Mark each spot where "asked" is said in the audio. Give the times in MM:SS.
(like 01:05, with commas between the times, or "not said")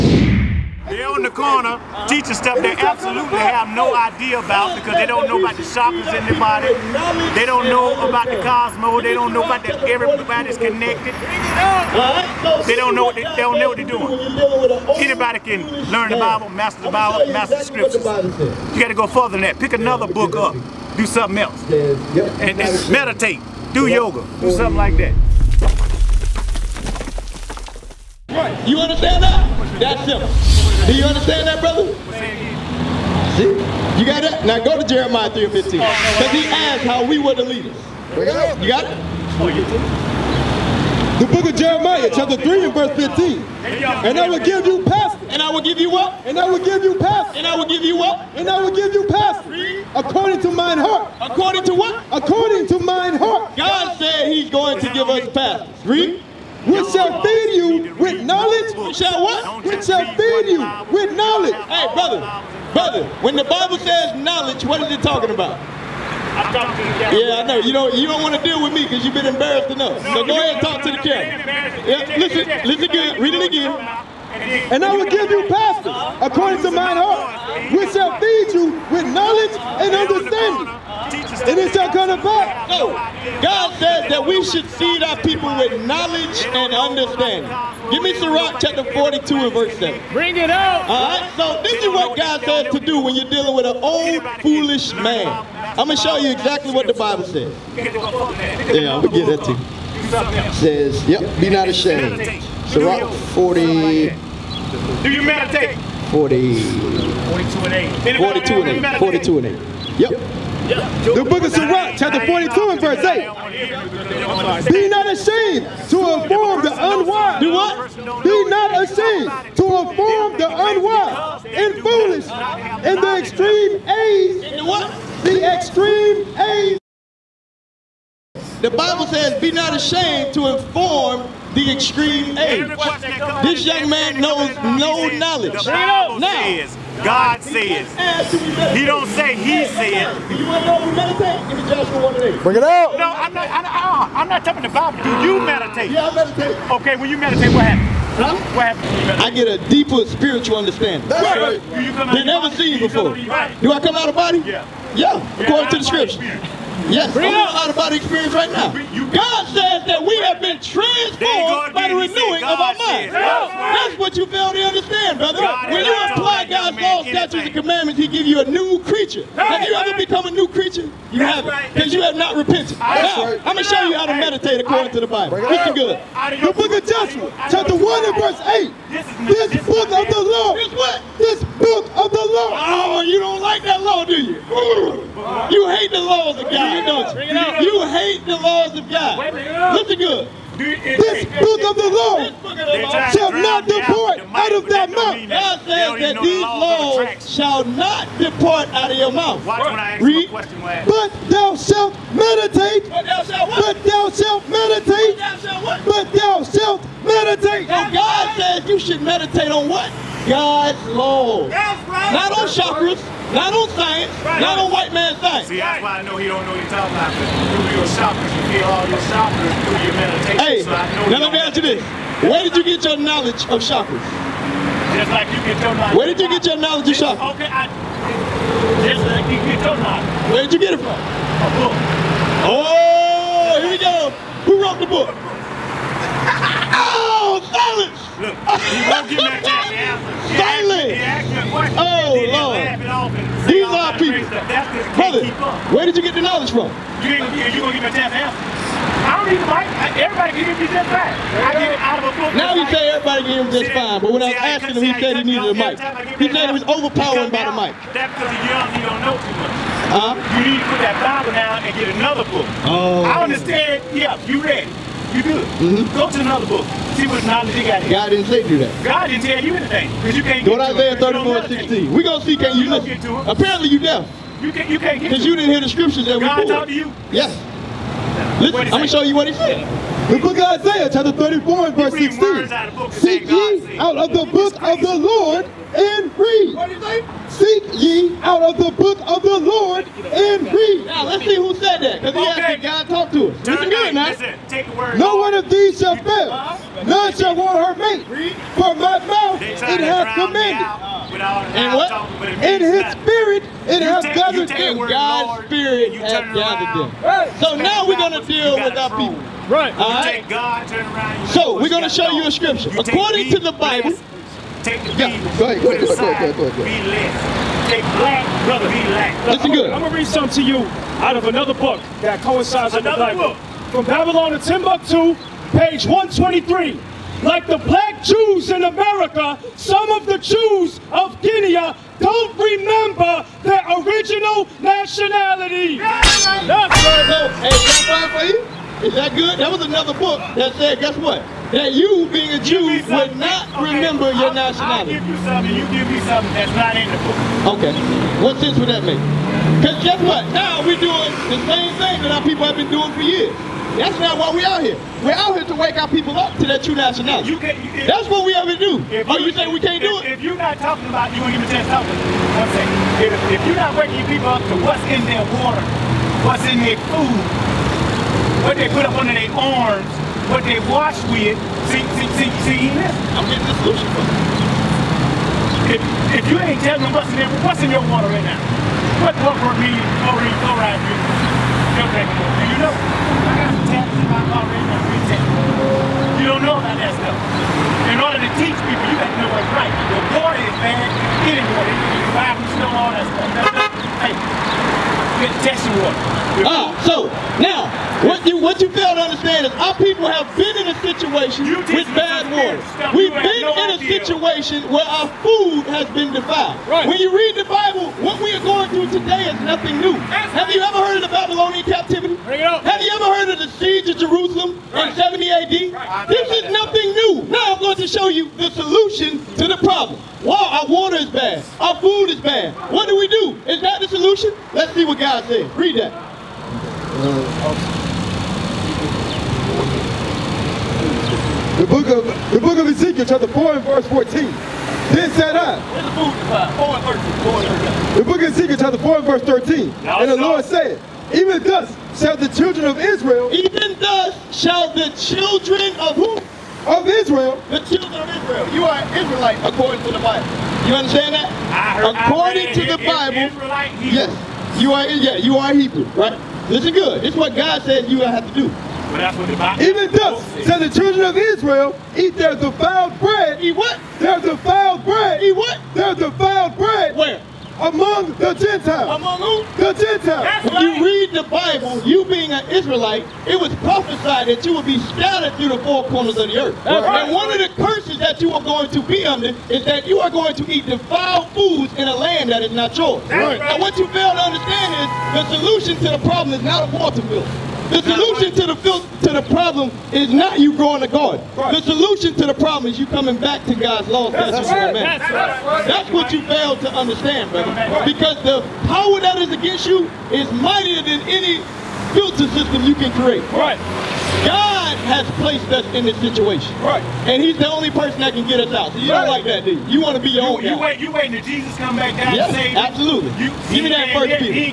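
00:36, 04:52.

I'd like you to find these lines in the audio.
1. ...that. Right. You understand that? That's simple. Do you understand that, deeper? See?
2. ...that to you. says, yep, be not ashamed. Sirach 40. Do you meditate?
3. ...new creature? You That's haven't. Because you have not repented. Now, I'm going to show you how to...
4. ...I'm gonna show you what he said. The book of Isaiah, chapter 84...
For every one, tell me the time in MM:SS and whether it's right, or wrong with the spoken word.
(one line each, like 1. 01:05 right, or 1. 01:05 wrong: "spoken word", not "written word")
1. 00:24 wrong: "brother", not "deeper"
2. 01:39 right
3. 02:50 right
4. 04:38 wrong: "34", not "84".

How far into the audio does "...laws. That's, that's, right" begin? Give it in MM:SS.
08:13.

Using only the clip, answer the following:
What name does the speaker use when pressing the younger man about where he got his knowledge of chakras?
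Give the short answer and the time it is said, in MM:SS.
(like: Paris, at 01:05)
Deshaun, at 03:46.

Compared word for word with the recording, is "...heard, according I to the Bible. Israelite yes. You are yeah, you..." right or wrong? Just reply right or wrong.
right.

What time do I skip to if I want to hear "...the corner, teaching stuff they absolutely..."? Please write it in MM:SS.
00:01.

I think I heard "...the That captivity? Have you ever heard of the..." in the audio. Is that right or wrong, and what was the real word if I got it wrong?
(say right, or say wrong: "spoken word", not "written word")
wrong: "Babylonian", not "That".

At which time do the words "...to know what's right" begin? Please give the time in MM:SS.
06:29.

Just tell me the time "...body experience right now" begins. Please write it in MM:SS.
02:37.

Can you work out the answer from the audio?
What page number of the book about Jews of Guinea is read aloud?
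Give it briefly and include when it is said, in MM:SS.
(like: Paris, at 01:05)
123, at 05:25.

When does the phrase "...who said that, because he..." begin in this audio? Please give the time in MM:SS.
04:51.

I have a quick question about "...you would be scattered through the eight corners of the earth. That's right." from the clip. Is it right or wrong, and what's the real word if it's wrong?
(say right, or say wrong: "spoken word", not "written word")
wrong: "four", not "eight".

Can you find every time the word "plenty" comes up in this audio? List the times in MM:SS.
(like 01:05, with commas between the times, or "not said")
not said.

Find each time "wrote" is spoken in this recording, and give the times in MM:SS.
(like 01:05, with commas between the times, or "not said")
03:54.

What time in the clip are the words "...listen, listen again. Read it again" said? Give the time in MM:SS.
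01:12.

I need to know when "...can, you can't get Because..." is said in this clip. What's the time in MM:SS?
04:34.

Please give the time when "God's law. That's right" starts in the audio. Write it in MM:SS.
03:30.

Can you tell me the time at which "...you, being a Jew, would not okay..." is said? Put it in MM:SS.
05:41.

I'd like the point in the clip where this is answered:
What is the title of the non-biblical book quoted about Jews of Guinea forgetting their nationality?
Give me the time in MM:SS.
05:23.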